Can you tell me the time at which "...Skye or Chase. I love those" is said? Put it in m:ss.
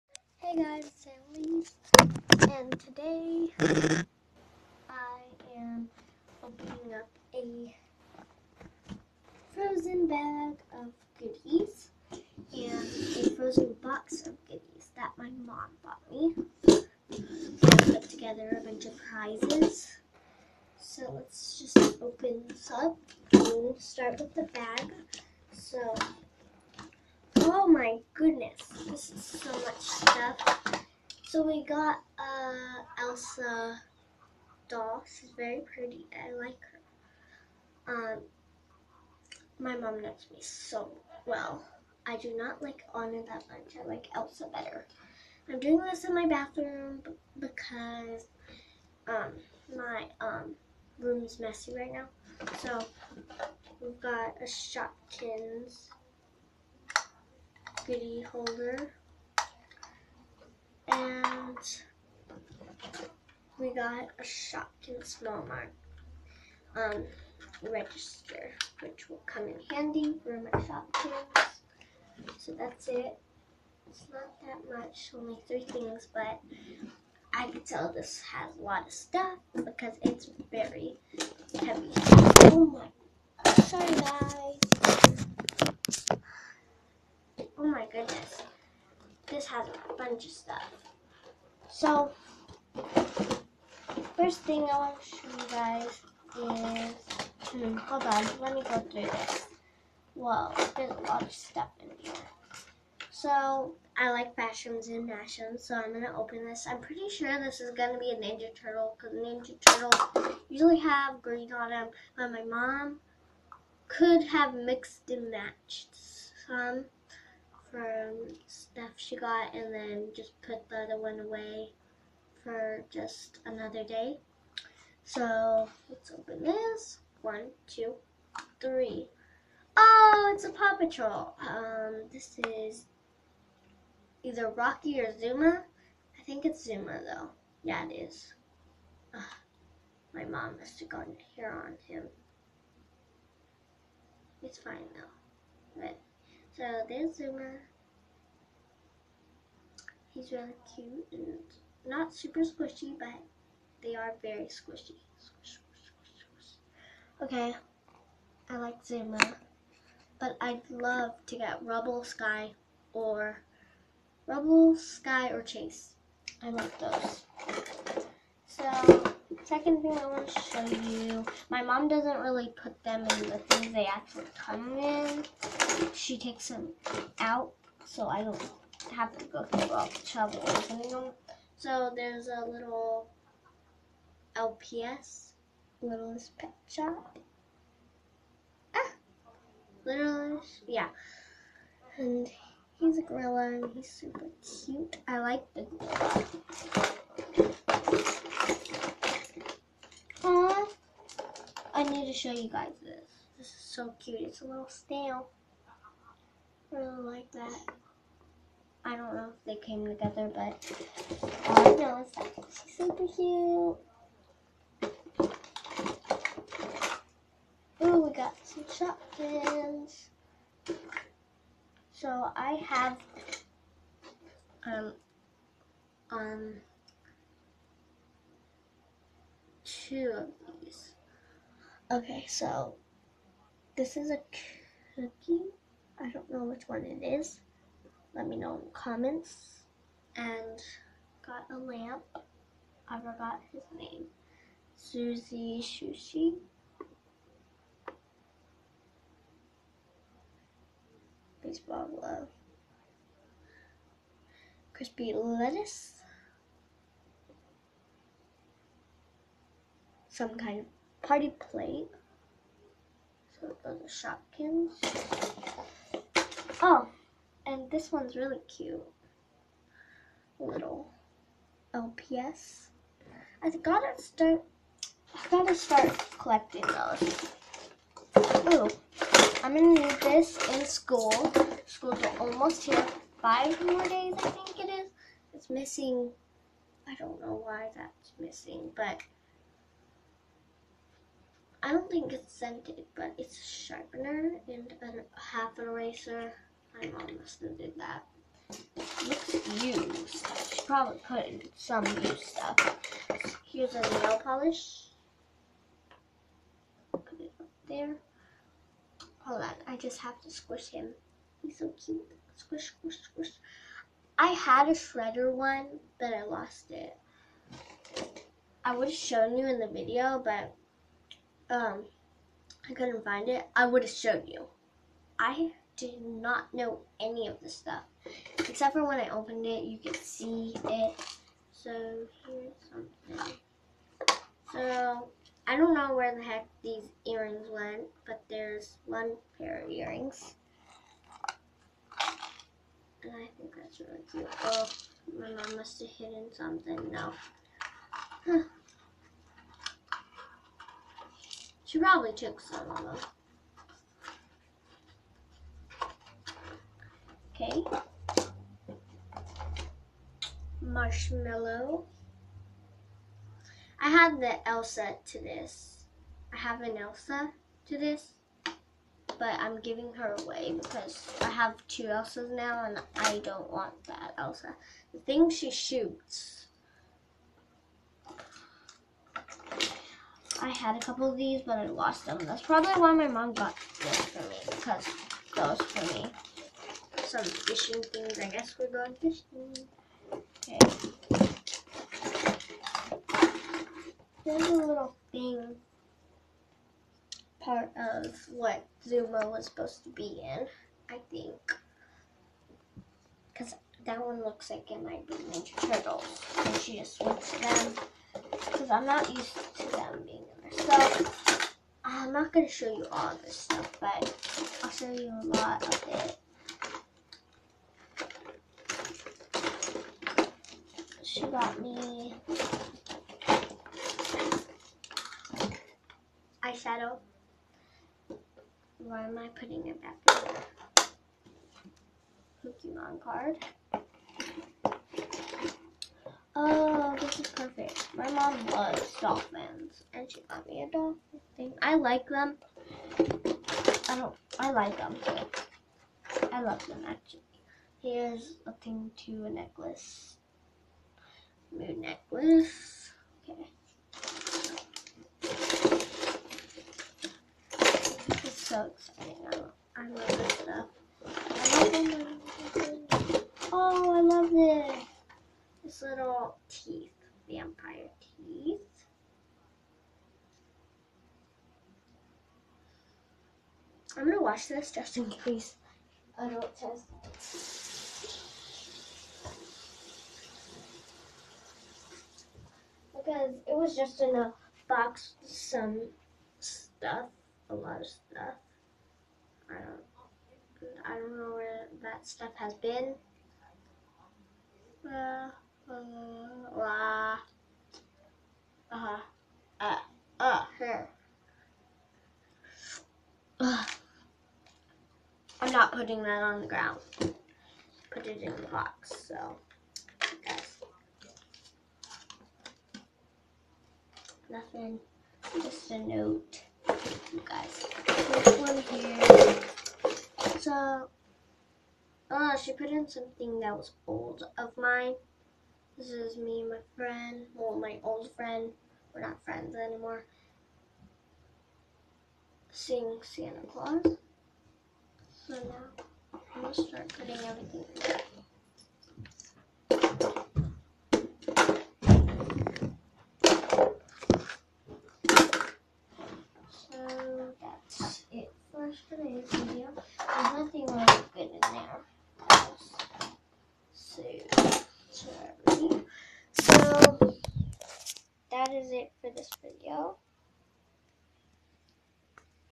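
2:44.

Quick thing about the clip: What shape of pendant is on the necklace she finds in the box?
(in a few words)
Moon.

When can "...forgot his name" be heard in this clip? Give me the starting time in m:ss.
4:02.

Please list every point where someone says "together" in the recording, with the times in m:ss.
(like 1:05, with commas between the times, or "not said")
0:18, 3:29.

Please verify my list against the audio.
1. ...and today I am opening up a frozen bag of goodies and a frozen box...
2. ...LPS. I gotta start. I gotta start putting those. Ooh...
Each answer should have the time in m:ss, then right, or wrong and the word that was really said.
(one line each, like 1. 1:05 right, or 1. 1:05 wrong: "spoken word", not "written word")
1. 0:02 right
2. 4:31 wrong: "collecting", not "putting".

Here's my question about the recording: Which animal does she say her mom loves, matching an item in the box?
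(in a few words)
Dolphins.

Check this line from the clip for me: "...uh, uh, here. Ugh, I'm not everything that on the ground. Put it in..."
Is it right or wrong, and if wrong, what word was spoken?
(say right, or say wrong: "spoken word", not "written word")
wrong: "putting", not "everything".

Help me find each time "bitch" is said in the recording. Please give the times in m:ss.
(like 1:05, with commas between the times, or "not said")
not said.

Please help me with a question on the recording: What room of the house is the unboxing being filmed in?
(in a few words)
Bathroom.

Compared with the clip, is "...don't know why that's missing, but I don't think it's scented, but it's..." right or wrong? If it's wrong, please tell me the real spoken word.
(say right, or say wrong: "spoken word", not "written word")
right.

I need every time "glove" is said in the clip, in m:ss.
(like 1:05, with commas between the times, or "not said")
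4:11.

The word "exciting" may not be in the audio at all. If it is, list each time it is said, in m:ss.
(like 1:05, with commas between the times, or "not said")
7:38.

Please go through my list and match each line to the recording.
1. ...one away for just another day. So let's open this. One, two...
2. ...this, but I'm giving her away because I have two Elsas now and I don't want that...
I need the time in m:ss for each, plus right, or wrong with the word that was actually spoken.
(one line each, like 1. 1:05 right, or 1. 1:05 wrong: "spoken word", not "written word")
1. 2:00 right
2. 6:07 right.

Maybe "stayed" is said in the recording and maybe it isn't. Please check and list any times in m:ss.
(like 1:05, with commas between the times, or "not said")
not said.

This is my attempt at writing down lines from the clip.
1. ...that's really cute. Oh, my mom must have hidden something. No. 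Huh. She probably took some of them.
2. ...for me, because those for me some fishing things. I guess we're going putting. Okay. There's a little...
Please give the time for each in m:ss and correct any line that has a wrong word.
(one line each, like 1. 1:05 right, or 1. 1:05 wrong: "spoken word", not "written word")
1. 5:43 right
2. 6:24 wrong: "fishing", not "putting".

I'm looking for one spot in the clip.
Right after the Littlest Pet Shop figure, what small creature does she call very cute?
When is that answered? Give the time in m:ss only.
3:24.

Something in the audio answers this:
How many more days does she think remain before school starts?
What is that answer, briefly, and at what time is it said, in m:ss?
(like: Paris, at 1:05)
5, at 4:43.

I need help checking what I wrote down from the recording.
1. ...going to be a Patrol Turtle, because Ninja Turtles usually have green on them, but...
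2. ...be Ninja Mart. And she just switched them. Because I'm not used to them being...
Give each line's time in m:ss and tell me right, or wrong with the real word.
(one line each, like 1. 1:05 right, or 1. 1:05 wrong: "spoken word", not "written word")
1. 1:47 wrong: "Ninja", not "Patrol"
2. 6:45 wrong: "Turtles", not "Mart".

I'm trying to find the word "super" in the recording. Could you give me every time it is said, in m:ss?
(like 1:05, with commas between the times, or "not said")
2:32, 3:13, 3:32.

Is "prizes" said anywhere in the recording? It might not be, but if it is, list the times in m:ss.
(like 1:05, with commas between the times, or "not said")
0:19.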